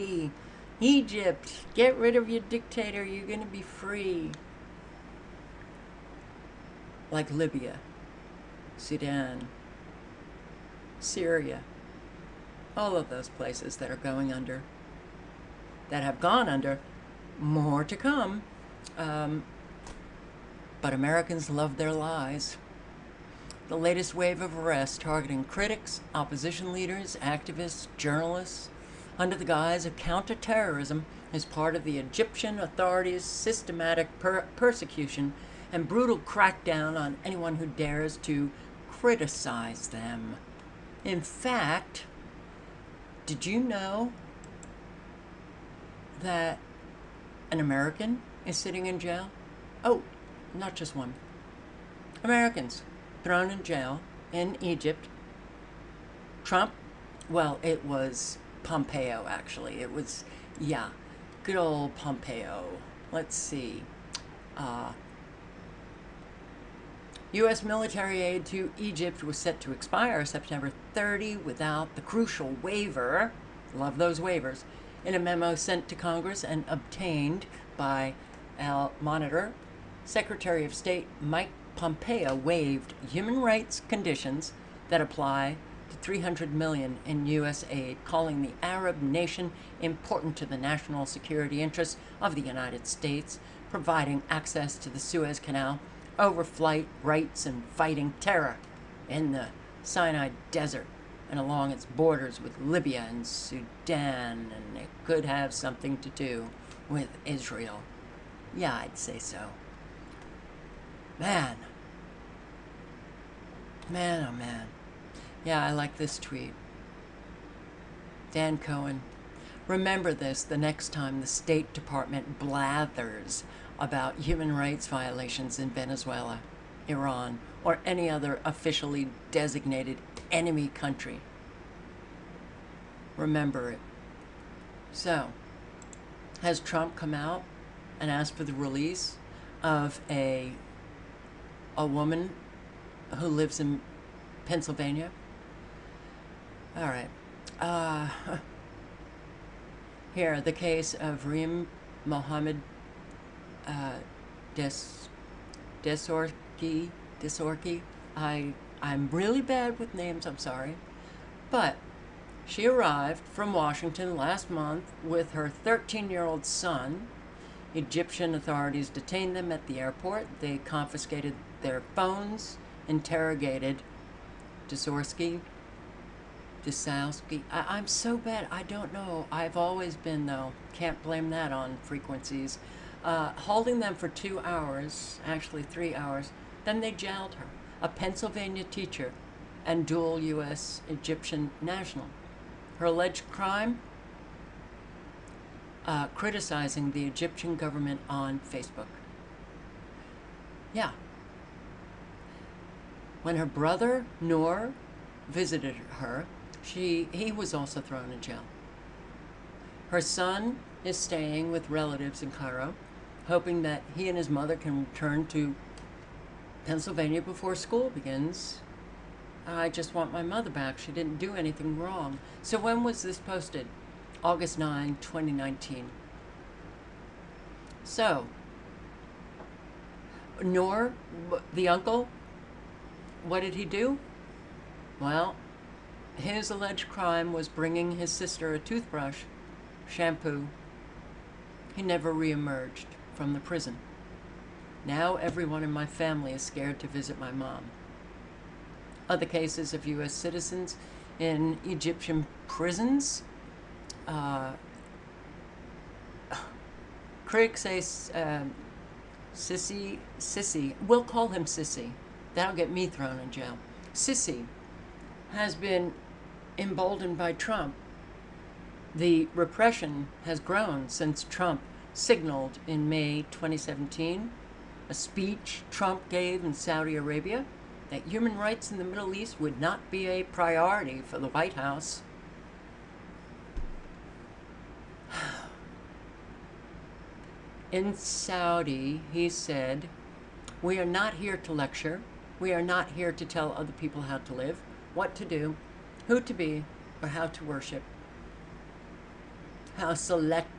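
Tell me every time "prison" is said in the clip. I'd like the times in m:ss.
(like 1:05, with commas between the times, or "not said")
4:03, 4:12.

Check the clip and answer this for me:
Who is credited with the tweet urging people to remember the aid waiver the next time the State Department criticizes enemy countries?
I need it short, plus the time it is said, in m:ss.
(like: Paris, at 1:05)
Dan Cohen, at 1:58.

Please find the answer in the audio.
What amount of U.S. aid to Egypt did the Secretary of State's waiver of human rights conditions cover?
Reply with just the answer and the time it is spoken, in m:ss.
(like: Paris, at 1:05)
300 million, at 1:25.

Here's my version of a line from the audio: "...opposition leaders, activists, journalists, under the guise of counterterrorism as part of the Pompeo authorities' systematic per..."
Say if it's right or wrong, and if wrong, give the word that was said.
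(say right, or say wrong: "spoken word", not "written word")
wrong: "Egyptian", not "Pompeo".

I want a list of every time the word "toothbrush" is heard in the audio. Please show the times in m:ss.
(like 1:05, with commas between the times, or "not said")
3:58.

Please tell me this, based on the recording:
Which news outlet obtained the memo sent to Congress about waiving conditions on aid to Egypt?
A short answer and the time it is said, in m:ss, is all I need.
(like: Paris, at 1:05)
Al Monitor, at 1:18.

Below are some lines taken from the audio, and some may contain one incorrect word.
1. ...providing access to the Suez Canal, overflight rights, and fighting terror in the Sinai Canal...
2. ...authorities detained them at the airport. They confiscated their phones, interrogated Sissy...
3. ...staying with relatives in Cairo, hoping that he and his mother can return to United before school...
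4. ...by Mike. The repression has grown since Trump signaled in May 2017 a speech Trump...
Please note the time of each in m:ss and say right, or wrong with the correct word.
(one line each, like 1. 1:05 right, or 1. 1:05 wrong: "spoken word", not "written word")
1. 1:33 wrong: "Desert", not "Canal"
2. 2:48 wrong: "Desorsky", not "Sissy"
3. 3:30 wrong: "Pennsylvania", not "United"
4. 4:27 wrong: "Trump", not "Mike".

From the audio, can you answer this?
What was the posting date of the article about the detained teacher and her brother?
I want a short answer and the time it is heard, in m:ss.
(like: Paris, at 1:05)
August 9, 2019, at 3:44.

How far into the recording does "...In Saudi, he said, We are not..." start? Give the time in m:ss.
4:47.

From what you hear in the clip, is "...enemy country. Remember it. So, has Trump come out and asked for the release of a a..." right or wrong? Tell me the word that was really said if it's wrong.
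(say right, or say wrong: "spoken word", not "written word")
right.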